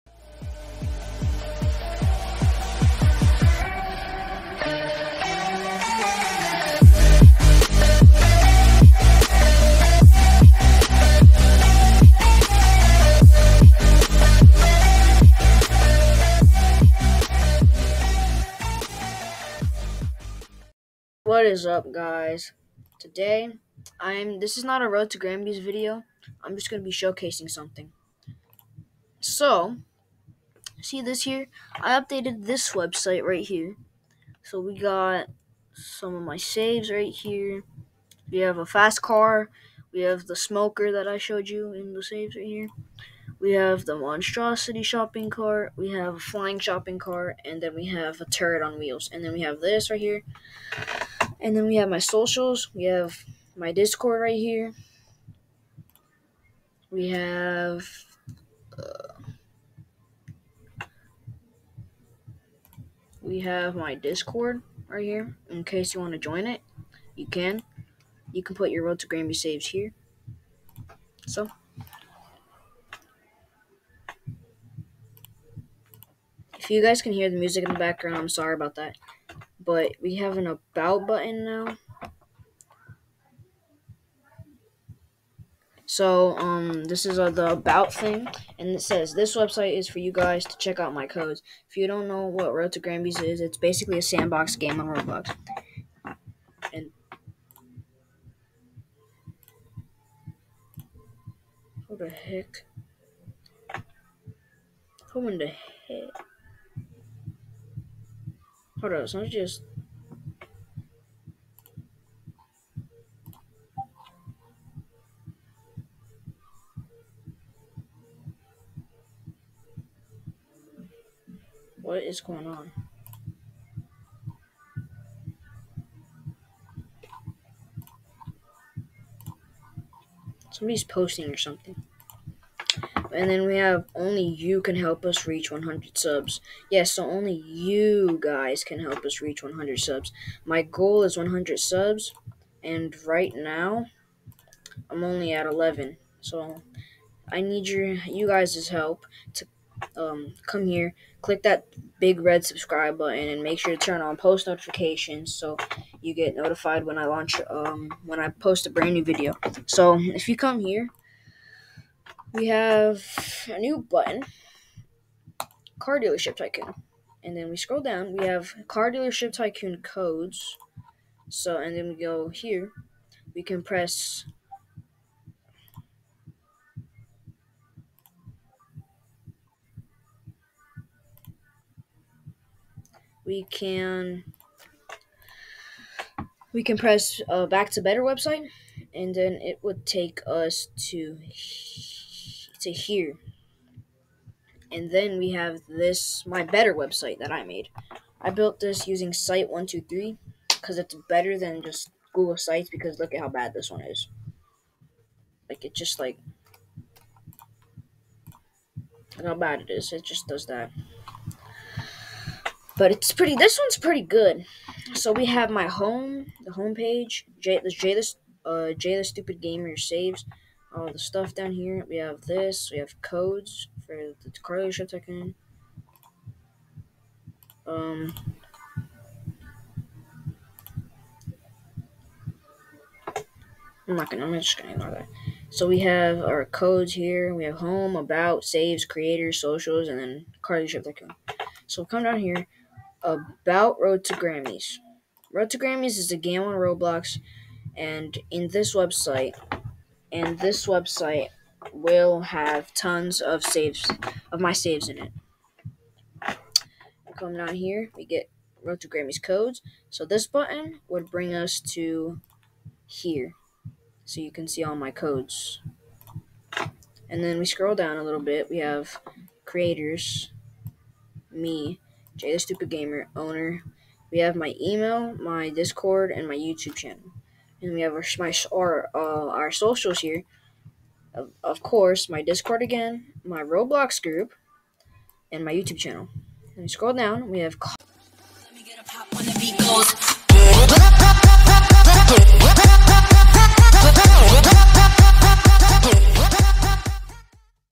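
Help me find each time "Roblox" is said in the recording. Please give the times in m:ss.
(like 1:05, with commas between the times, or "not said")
1:34, 4:06, 4:43.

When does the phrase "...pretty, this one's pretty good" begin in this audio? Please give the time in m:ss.
3:33.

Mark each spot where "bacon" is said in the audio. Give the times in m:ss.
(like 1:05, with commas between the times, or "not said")
not said.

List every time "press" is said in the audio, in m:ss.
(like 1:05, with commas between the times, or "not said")
2:53, 3:06.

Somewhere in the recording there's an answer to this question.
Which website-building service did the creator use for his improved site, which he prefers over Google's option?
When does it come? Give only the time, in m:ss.
3:19.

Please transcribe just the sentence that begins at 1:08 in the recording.
You can put your Road to Gramby saves here.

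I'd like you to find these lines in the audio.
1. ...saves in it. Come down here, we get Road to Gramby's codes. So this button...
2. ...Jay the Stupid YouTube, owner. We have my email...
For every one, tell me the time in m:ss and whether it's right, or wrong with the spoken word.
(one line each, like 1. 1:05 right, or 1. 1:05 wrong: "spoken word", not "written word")
1. 4:14 right
2. 4:32 wrong: "Gamer", not "YouTube".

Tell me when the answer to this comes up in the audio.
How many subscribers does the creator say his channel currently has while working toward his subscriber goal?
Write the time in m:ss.
2:25.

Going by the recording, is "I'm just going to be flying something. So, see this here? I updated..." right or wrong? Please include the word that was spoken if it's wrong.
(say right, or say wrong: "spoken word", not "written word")
wrong: "showcasing", not "flying".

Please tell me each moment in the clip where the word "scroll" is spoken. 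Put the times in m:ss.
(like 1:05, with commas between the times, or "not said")
2:47, 4:27, 4:46.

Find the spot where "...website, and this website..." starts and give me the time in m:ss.
4:08.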